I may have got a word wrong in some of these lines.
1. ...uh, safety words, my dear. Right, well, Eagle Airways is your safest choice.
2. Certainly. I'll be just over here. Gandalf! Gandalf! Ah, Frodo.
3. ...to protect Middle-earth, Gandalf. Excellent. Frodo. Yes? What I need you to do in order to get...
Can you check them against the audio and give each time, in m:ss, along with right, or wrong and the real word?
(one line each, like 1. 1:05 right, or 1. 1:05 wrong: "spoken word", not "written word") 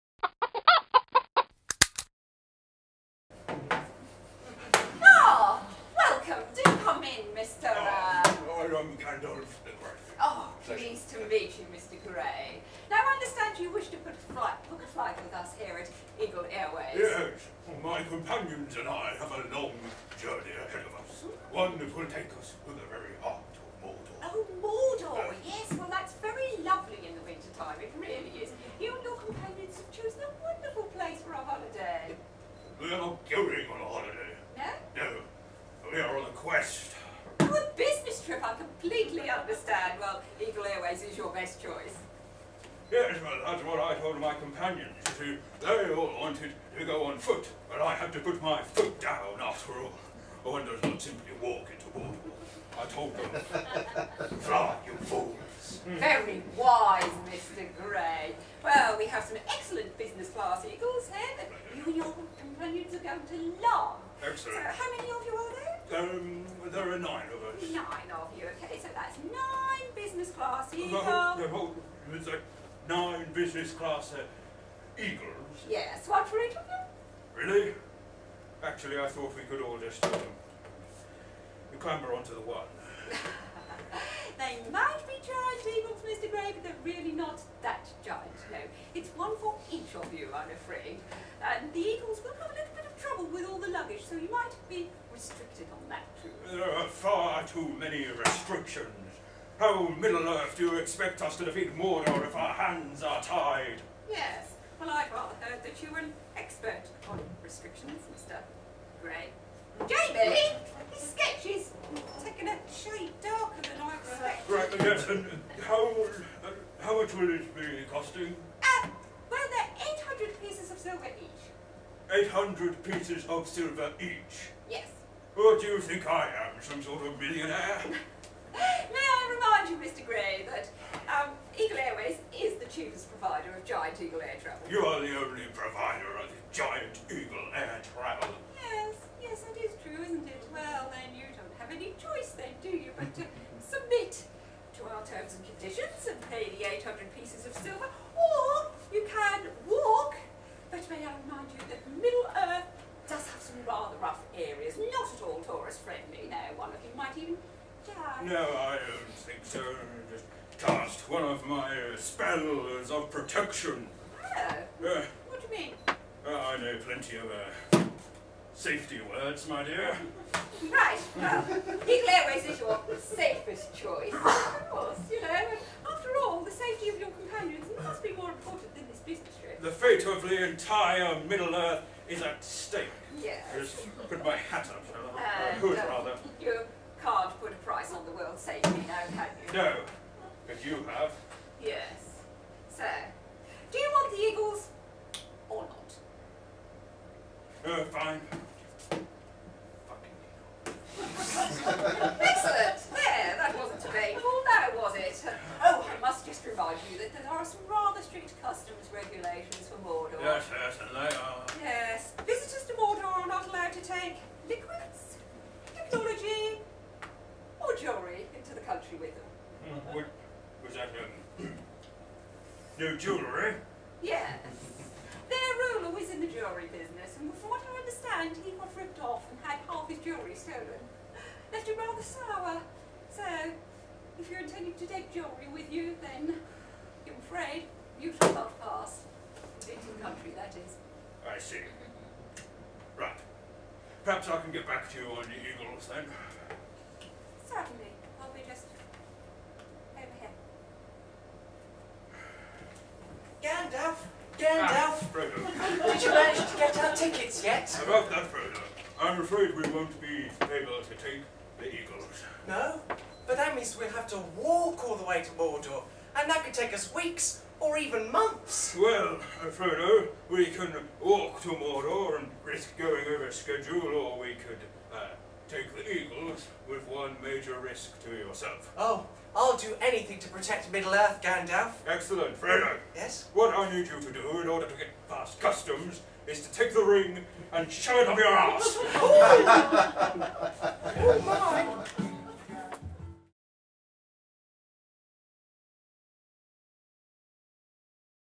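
1. 2:47 right
2. 4:07 right
3. 4:40 right.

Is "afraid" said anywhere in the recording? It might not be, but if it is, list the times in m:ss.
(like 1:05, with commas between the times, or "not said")
3:57, 4:19.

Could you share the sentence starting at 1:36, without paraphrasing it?
There are far too many restrictions.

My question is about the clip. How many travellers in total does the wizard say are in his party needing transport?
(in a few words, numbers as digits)
9.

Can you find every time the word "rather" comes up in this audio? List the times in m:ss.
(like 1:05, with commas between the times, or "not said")
1:45, 3:05, 3:27.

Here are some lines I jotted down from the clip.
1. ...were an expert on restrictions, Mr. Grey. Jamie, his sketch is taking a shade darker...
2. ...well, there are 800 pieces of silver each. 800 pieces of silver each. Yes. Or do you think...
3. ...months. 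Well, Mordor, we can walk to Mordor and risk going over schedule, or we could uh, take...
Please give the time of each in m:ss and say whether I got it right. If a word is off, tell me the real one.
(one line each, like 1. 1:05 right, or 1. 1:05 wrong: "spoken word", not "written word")
1. 1:45 right
2. 1:59 right
3. 4:28 wrong: "Frodo", not "Mordor".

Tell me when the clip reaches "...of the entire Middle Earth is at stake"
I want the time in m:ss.
3:00.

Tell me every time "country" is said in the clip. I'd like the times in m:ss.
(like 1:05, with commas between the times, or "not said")
3:38, 4:00.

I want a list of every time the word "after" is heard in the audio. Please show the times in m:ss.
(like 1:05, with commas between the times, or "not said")
0:49, 2:55.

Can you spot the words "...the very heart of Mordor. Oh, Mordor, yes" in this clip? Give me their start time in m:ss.
0:22.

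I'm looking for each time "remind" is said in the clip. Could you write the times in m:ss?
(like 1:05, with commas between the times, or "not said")
2:09, 3:26.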